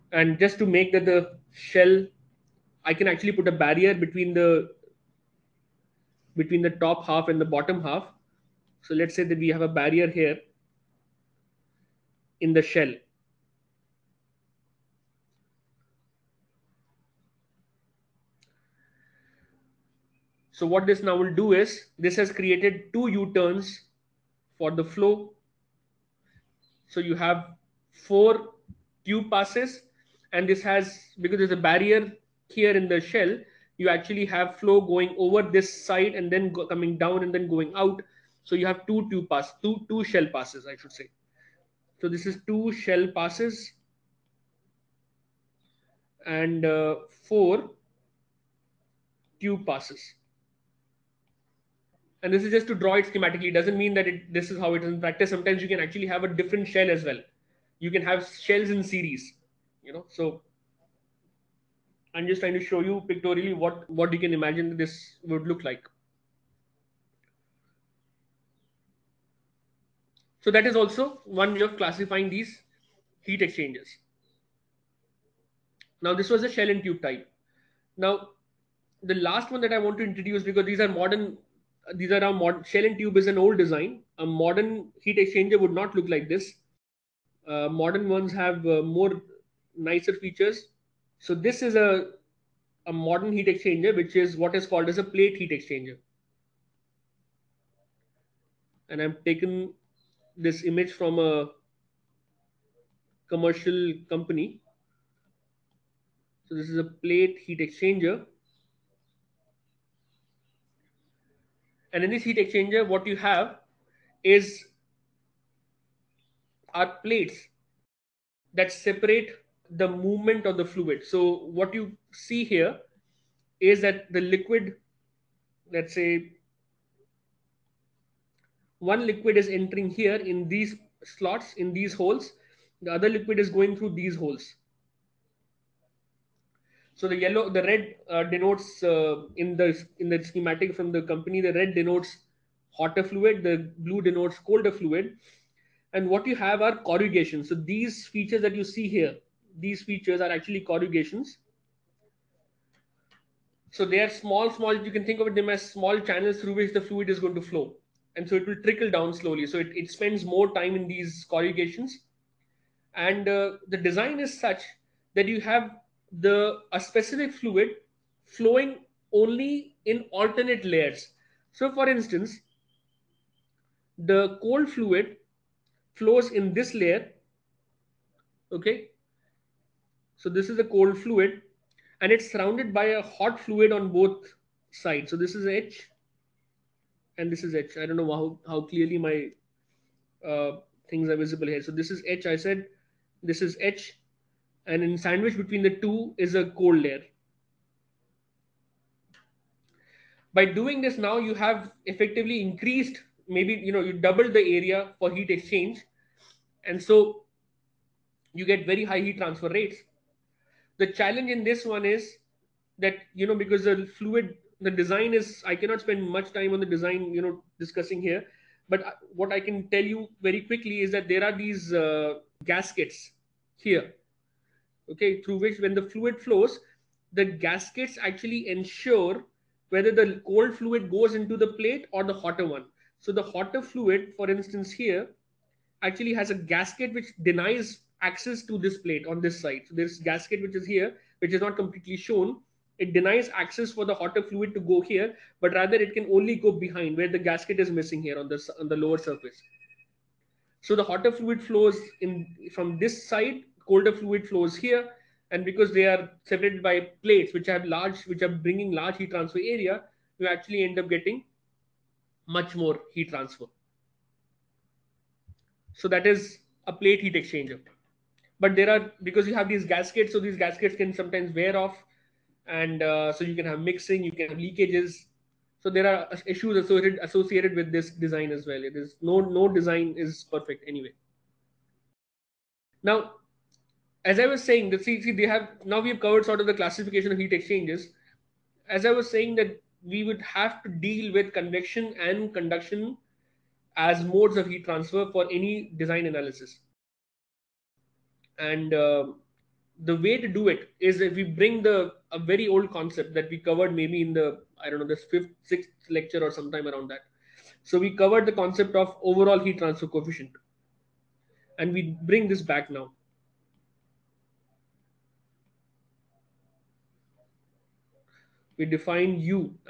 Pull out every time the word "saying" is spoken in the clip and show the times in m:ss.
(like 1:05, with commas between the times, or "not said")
4:44, 4:49.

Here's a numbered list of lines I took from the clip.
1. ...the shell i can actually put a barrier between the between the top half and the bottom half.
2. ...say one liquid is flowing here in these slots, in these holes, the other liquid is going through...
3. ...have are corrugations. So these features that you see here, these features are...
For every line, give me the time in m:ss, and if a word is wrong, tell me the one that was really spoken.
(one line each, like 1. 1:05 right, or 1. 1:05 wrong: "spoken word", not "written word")
1. 0:01 right
2. 2:05 wrong: "entering", not "flowing"
3. 2:26 right.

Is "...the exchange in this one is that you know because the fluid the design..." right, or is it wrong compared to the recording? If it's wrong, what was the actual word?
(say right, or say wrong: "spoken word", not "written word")
wrong: "challenge", not "exchange".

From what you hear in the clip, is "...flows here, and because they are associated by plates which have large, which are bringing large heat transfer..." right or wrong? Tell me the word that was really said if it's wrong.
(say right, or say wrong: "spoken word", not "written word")
wrong: "separated", not "associated".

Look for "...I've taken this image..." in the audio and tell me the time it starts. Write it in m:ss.
1:39.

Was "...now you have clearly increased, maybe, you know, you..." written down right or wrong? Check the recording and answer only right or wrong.
wrong.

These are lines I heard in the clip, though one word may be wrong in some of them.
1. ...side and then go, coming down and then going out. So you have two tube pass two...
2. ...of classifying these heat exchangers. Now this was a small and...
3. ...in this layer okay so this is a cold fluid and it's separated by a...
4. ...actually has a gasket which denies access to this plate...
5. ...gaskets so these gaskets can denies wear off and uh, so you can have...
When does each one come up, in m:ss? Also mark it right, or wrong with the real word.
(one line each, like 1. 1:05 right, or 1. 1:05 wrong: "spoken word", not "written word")
1. 0:35 right
2. 1:11 wrong: "shell", not "small"
3. 2:56 wrong: "surrounded", not "separated"
4. 3:55 right
5. 4:29 wrong: "sometimes", not "denies".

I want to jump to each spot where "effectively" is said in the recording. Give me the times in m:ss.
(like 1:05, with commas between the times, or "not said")
3:21.